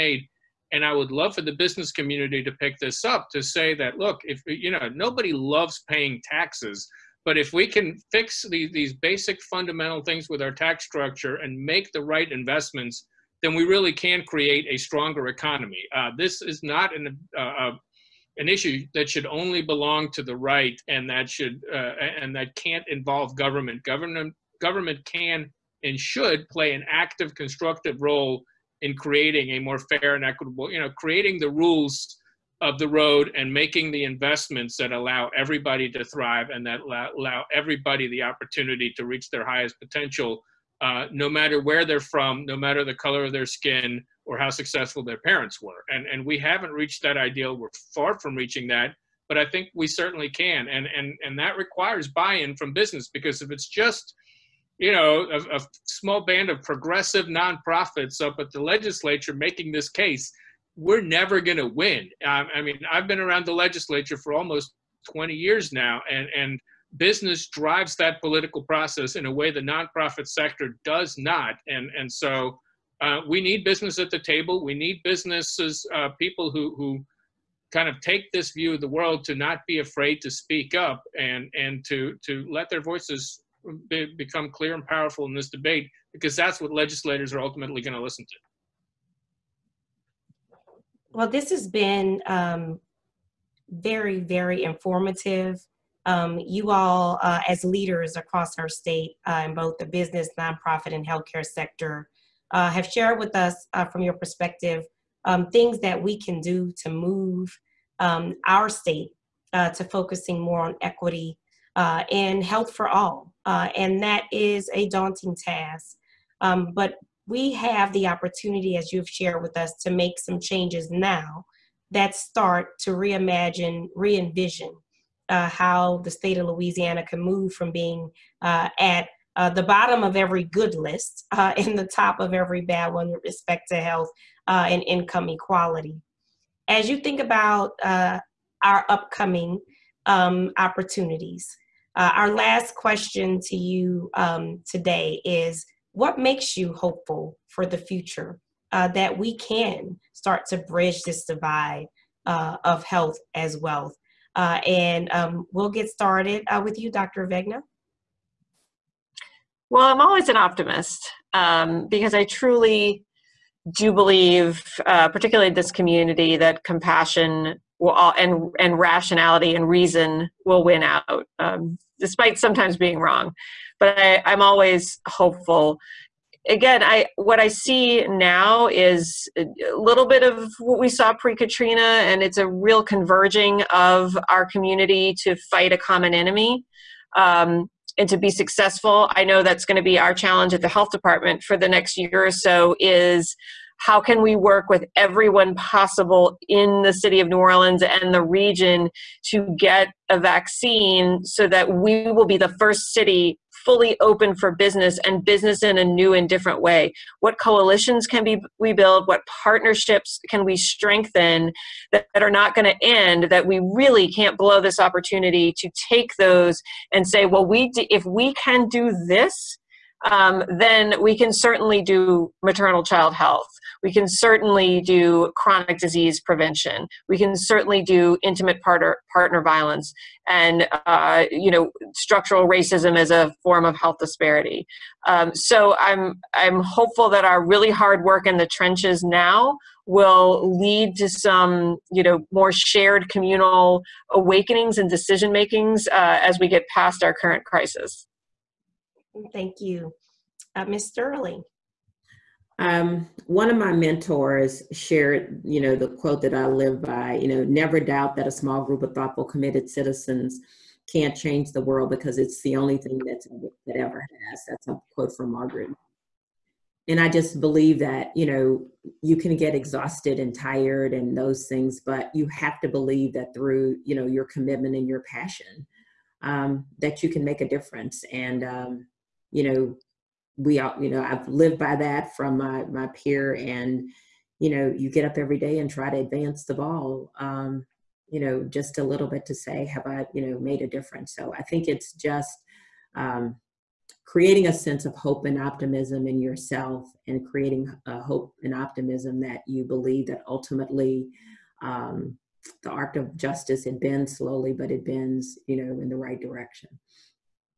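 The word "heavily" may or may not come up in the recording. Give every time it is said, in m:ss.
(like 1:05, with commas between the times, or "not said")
not said.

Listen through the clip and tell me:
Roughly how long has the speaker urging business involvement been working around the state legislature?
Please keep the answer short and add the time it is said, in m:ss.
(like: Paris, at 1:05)
almost 20 years, at 1:04.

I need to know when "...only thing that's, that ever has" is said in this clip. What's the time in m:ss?
4:22.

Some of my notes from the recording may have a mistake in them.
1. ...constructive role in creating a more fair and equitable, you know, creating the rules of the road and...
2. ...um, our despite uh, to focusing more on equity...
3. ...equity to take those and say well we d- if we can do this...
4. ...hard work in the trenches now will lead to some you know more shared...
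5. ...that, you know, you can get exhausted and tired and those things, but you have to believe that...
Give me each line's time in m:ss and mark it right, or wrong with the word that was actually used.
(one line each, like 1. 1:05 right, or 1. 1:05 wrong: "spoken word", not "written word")
1. 0:27 right
2. 1:47 wrong: "state", not "despite"
3. 3:34 wrong: "opportunity", not "equity"
4. 3:57 right
5. 4:27 right.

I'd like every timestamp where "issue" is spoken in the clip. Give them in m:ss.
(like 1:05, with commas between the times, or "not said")
0:18.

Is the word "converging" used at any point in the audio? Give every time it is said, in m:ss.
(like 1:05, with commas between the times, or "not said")
3:02.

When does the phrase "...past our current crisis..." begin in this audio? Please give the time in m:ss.
4:06.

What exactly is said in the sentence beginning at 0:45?
And, and we haven't reached that ideal.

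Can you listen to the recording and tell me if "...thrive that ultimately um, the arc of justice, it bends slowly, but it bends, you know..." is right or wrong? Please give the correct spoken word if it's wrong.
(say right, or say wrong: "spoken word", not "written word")
wrong: "believe", not "thrive".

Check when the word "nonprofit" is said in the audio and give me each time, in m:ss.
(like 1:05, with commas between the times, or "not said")
0:57, 1:09, 1:40.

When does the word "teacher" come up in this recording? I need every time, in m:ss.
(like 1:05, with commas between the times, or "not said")
not said.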